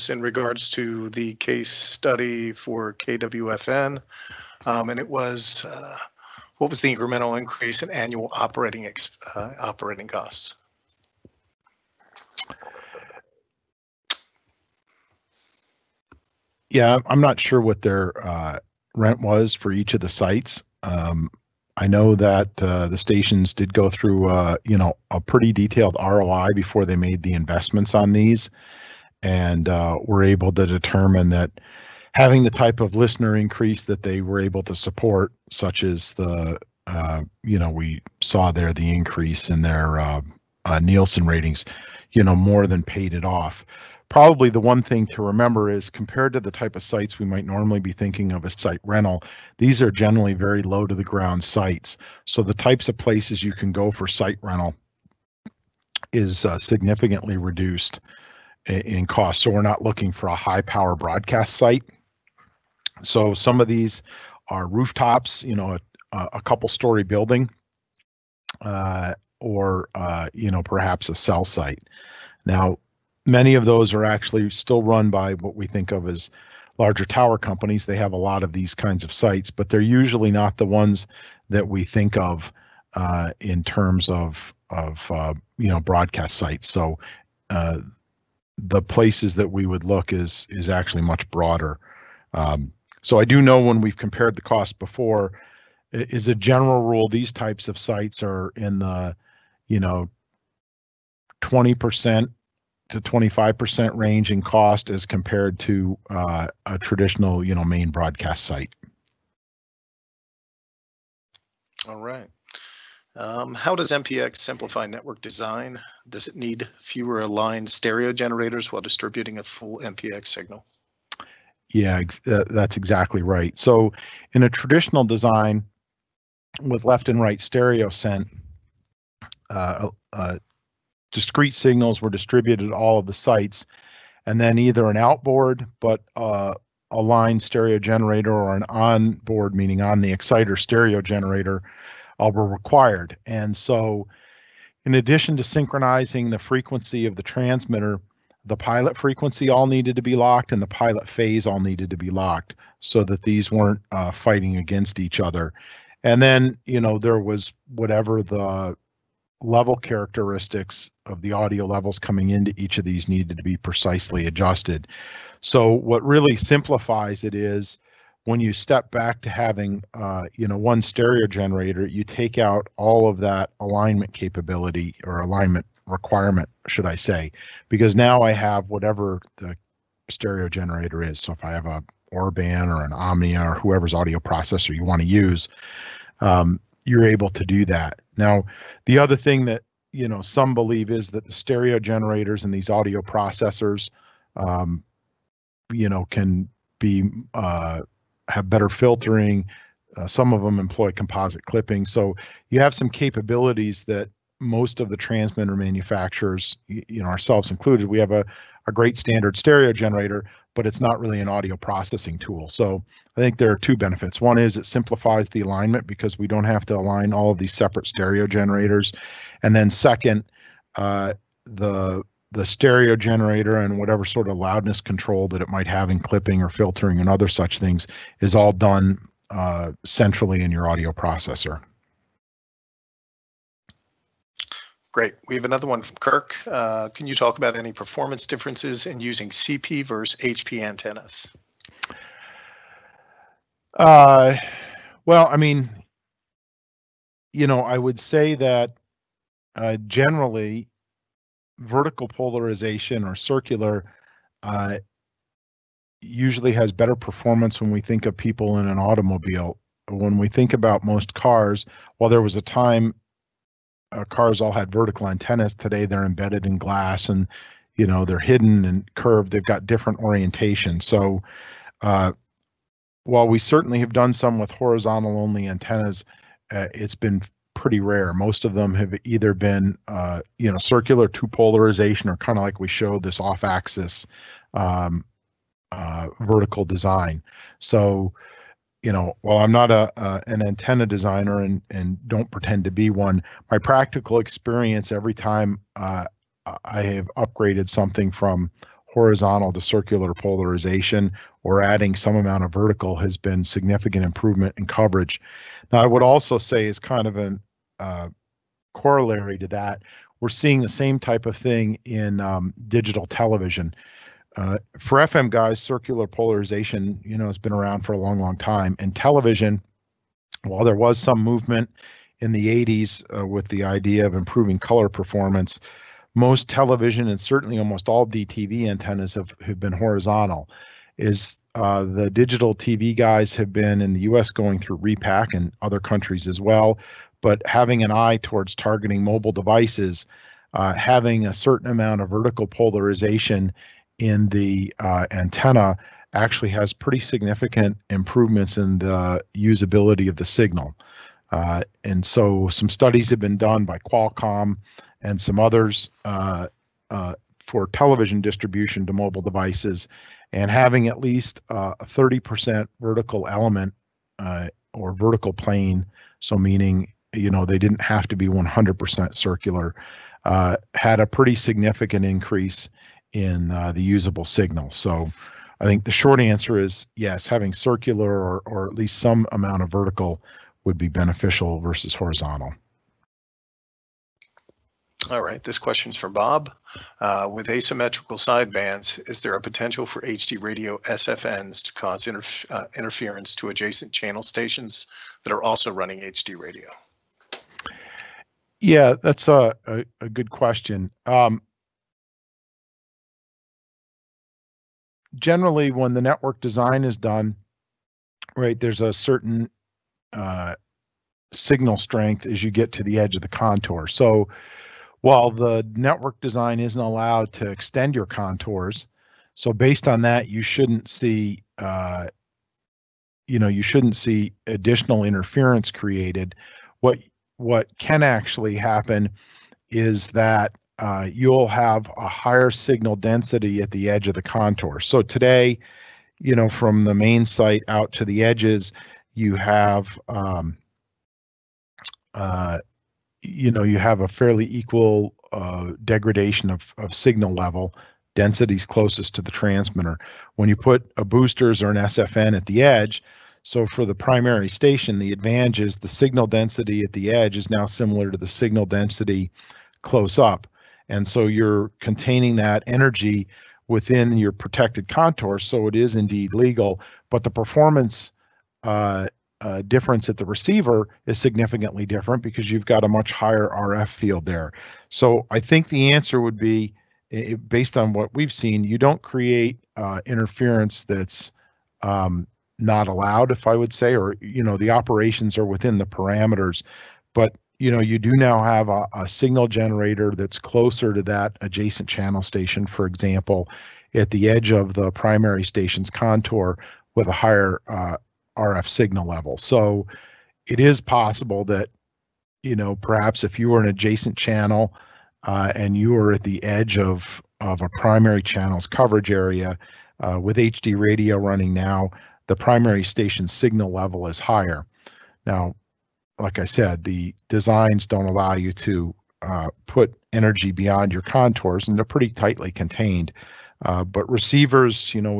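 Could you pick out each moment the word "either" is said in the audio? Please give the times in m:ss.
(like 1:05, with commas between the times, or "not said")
2:14, 4:39.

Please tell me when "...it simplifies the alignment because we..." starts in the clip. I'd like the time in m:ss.
3:34.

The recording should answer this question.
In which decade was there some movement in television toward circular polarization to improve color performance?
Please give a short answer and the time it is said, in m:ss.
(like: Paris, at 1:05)
1980s, at 5:22.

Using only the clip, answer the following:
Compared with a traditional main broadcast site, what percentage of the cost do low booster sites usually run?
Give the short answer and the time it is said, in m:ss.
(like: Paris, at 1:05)
20% to 25%, at 1:41.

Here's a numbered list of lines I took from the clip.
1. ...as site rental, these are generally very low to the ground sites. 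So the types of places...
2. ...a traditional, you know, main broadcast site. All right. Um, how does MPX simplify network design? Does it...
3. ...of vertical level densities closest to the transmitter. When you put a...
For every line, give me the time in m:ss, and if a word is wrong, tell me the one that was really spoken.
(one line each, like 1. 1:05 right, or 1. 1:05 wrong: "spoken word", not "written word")
1. 0:48 right
2. 1:46 right
3. 7:26 wrong: "signal", not "vertical".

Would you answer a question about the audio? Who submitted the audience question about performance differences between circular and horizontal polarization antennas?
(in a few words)
Kirk.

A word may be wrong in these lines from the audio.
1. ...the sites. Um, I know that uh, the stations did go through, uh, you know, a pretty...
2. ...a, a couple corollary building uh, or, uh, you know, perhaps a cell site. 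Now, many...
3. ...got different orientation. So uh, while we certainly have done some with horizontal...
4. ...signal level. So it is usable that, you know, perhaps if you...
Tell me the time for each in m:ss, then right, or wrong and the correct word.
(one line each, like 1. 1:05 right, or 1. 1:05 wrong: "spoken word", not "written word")
1. 0:19 right
2. 1:06 wrong: "story", not "corollary"
3. 4:29 right
4. 8:18 wrong: "possible", not "usable".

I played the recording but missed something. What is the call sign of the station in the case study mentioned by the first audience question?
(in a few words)
KWFN.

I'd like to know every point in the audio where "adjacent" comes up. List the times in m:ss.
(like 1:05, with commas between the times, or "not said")
6:33, 8:11, 8:23.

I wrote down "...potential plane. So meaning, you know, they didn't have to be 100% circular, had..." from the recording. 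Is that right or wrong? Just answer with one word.
wrong.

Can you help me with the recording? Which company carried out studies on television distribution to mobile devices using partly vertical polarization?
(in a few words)
Qualcomm.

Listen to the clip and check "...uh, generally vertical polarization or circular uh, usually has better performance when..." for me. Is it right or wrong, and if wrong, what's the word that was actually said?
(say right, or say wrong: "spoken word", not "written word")
right.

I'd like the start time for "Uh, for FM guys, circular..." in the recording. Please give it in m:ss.
5:14.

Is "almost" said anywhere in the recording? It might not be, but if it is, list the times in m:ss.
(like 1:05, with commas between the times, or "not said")
5:27.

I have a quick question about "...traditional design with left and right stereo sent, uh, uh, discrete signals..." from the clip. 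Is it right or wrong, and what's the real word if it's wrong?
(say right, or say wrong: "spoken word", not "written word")
right.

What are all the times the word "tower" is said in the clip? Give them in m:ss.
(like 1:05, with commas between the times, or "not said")
1:17.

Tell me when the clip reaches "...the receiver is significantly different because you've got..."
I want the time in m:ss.
7:50.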